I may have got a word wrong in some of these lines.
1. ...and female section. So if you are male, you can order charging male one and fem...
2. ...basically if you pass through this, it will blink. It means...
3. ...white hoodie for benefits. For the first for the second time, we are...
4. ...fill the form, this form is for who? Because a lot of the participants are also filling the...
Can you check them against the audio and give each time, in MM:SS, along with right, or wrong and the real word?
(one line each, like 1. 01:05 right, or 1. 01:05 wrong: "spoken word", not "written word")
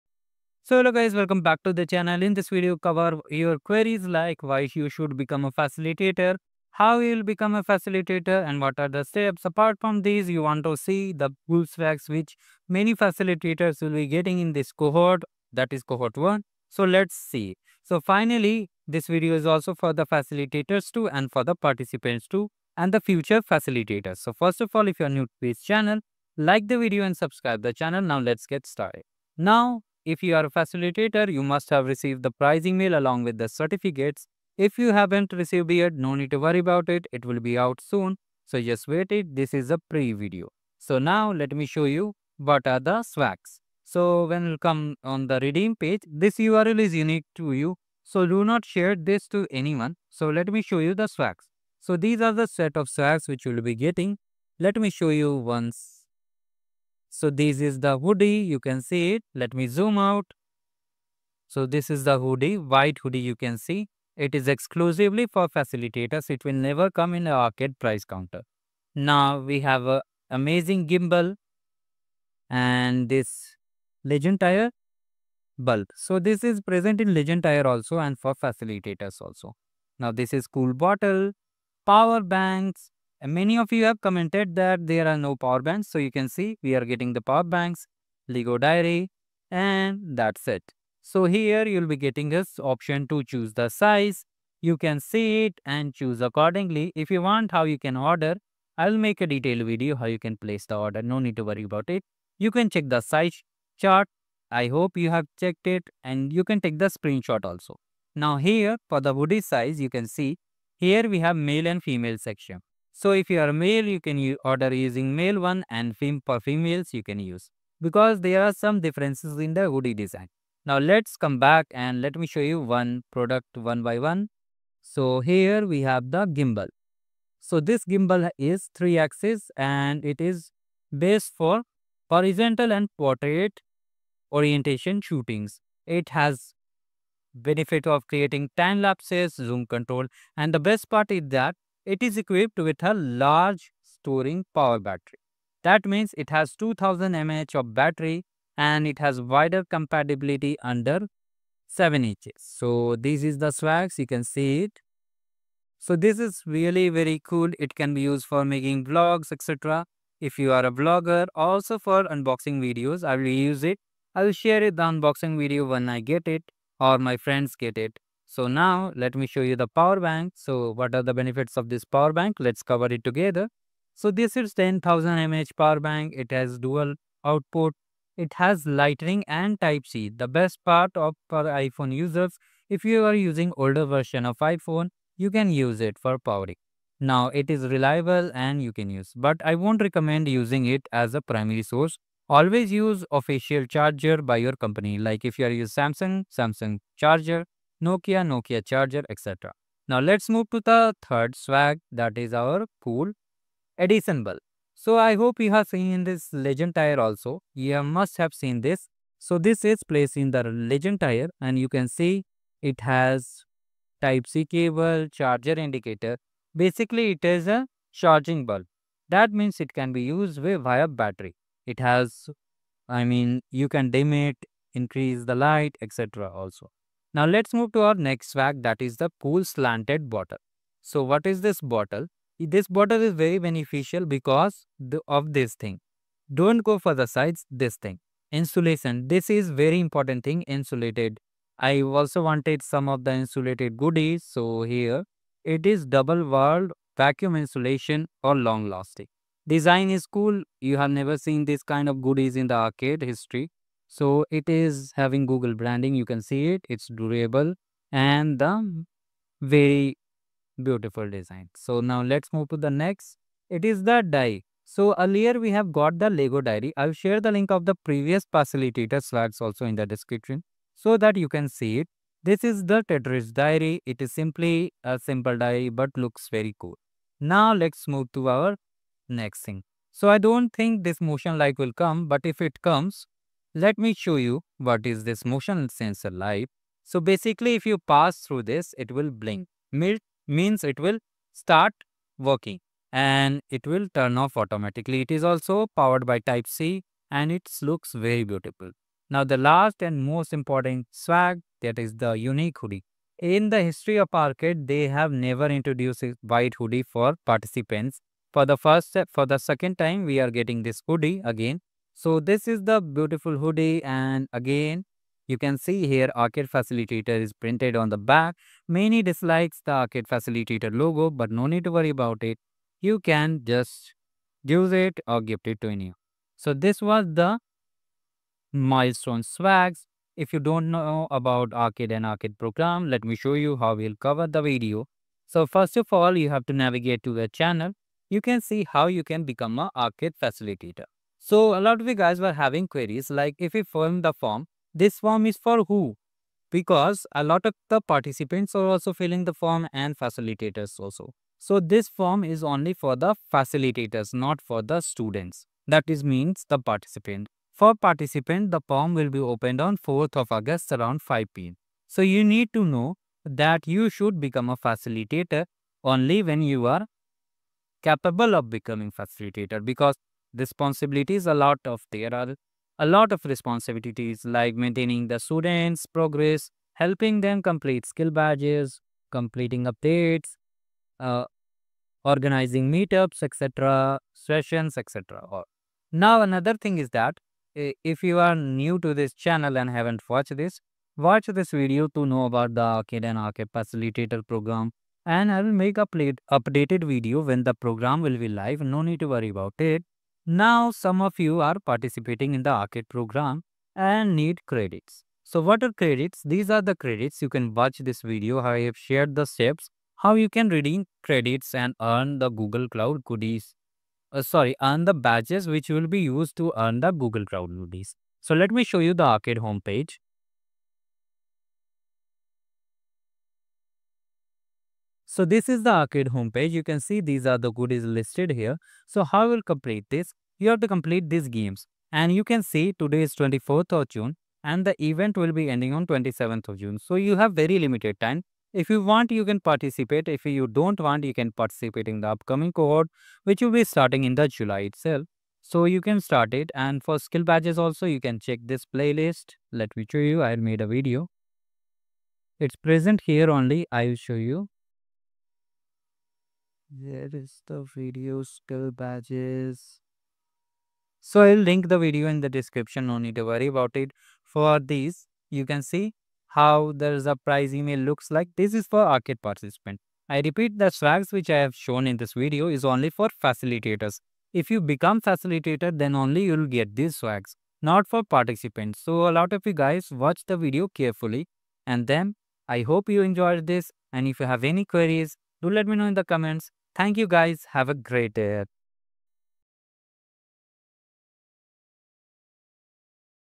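1. 01:51 wrong: "using", not "charging"
2. 04:47 right
3. 05:06 wrong: "participants", not "benefits"
4. 05:43 right.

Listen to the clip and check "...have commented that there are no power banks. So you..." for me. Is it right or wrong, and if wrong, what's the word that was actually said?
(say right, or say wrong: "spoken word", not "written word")
right.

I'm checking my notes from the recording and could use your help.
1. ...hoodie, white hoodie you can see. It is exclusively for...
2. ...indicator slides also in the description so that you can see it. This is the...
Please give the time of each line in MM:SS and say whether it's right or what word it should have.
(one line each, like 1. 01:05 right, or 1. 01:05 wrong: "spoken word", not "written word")
1. 01:02 right
2. 04:28 wrong: "facilitator", not "indicator".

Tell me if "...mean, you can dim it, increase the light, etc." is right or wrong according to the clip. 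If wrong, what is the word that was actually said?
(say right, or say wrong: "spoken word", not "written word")
right.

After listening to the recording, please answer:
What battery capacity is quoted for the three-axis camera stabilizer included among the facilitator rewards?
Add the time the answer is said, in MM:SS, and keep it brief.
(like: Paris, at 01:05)
2000 mAh, at 02:26.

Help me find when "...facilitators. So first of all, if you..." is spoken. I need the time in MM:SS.
00:23.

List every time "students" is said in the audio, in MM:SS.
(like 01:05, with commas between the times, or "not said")
05:54, 06:15.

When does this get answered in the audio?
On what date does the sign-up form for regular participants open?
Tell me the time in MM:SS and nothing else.
05:59.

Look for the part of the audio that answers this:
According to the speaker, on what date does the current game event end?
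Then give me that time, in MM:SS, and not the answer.
07:15.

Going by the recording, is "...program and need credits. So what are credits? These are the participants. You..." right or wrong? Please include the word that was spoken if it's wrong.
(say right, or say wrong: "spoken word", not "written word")
wrong: "credits", not "participants".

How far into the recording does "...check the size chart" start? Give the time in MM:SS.
01:42.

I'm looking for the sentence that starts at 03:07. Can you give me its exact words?
Now it is reliable and you can use, but I won't recommend using it as a primary source.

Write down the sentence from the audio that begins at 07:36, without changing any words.
There is the video skill badges.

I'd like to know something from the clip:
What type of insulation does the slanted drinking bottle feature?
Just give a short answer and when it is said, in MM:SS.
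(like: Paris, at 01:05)
Double walled vacuum insulation, at 04:05.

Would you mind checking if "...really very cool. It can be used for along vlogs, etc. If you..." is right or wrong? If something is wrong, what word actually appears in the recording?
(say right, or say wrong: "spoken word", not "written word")
wrong: "making", not "along".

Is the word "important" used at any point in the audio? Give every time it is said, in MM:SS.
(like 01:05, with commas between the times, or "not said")
03:59, 05:00.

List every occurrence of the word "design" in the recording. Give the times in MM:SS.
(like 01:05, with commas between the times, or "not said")
01:59, 04:09, 04:21.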